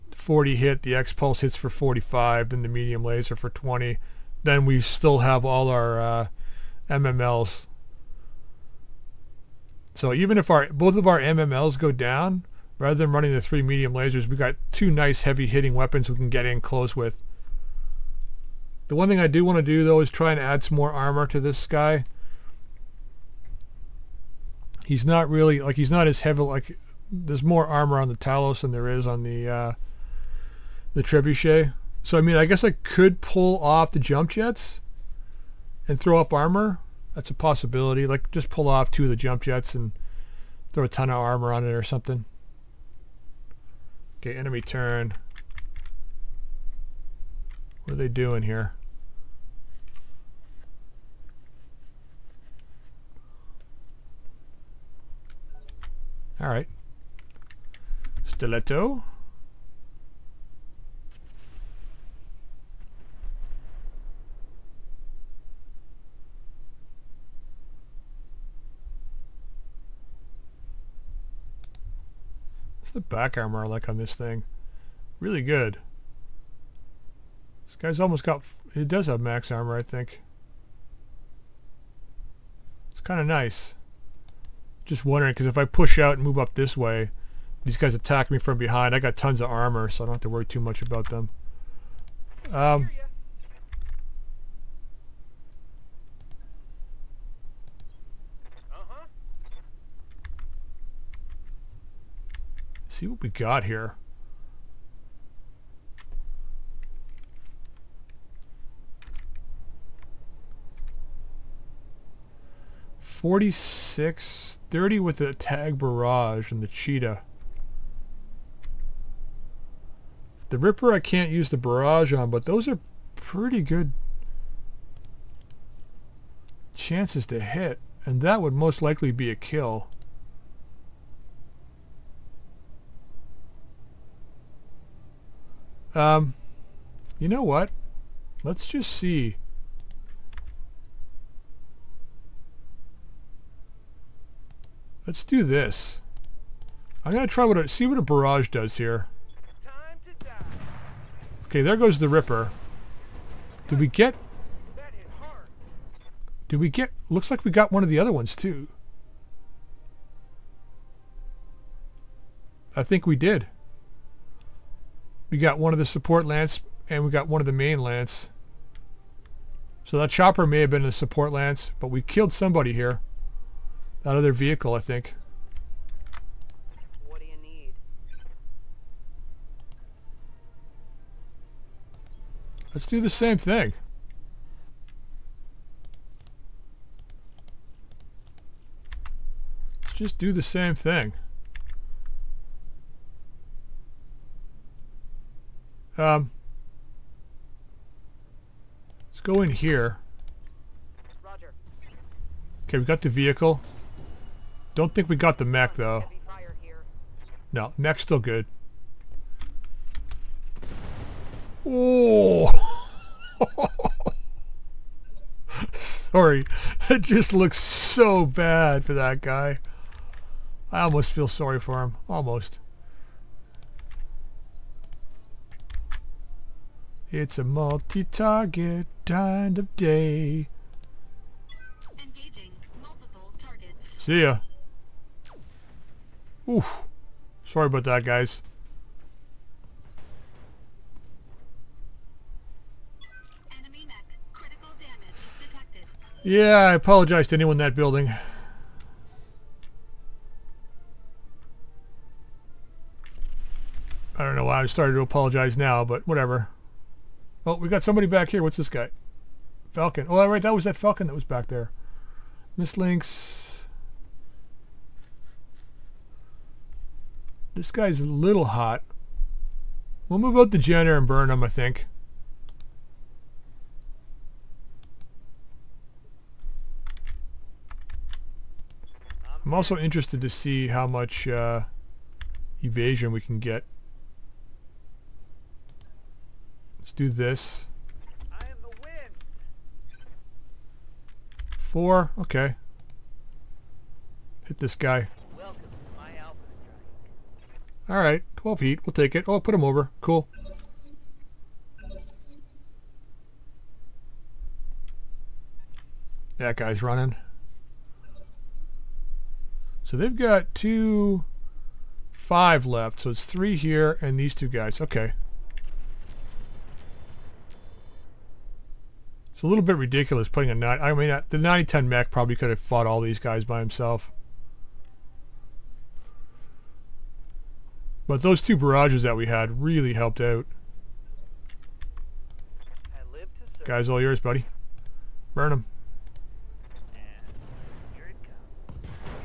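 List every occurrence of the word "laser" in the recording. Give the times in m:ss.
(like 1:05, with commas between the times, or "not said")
0:03, 0:13.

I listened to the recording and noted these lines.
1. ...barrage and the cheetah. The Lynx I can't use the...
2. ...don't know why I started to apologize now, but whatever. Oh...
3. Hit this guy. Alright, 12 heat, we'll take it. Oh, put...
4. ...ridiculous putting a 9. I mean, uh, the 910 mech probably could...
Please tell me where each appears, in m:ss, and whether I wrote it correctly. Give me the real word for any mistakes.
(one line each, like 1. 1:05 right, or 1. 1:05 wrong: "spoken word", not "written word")
1. 1:55 wrong: "Ripper", not "Lynx"
2. 4:14 right
3. 4:54 right
4. 5:19 right.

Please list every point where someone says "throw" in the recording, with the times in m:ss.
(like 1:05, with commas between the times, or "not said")
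0:35, 0:40.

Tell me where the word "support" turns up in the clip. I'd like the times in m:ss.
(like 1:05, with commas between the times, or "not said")
2:45, 2:50.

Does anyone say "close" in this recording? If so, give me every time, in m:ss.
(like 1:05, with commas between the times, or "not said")
0:16.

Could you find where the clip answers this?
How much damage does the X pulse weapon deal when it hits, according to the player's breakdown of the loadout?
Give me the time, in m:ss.
0:01.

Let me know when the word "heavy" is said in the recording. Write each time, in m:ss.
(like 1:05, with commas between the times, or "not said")
0:15, 0:26.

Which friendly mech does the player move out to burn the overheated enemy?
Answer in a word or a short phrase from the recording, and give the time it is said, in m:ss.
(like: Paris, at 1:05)
Jenner, at 4:30.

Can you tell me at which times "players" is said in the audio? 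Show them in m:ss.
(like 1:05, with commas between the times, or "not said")
not said.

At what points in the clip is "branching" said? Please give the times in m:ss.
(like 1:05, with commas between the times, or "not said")
not said.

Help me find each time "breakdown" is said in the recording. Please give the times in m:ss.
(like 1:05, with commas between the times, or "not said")
not said.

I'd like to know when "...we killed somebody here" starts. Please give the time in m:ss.
2:51.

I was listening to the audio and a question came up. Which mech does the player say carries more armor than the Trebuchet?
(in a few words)
Talos.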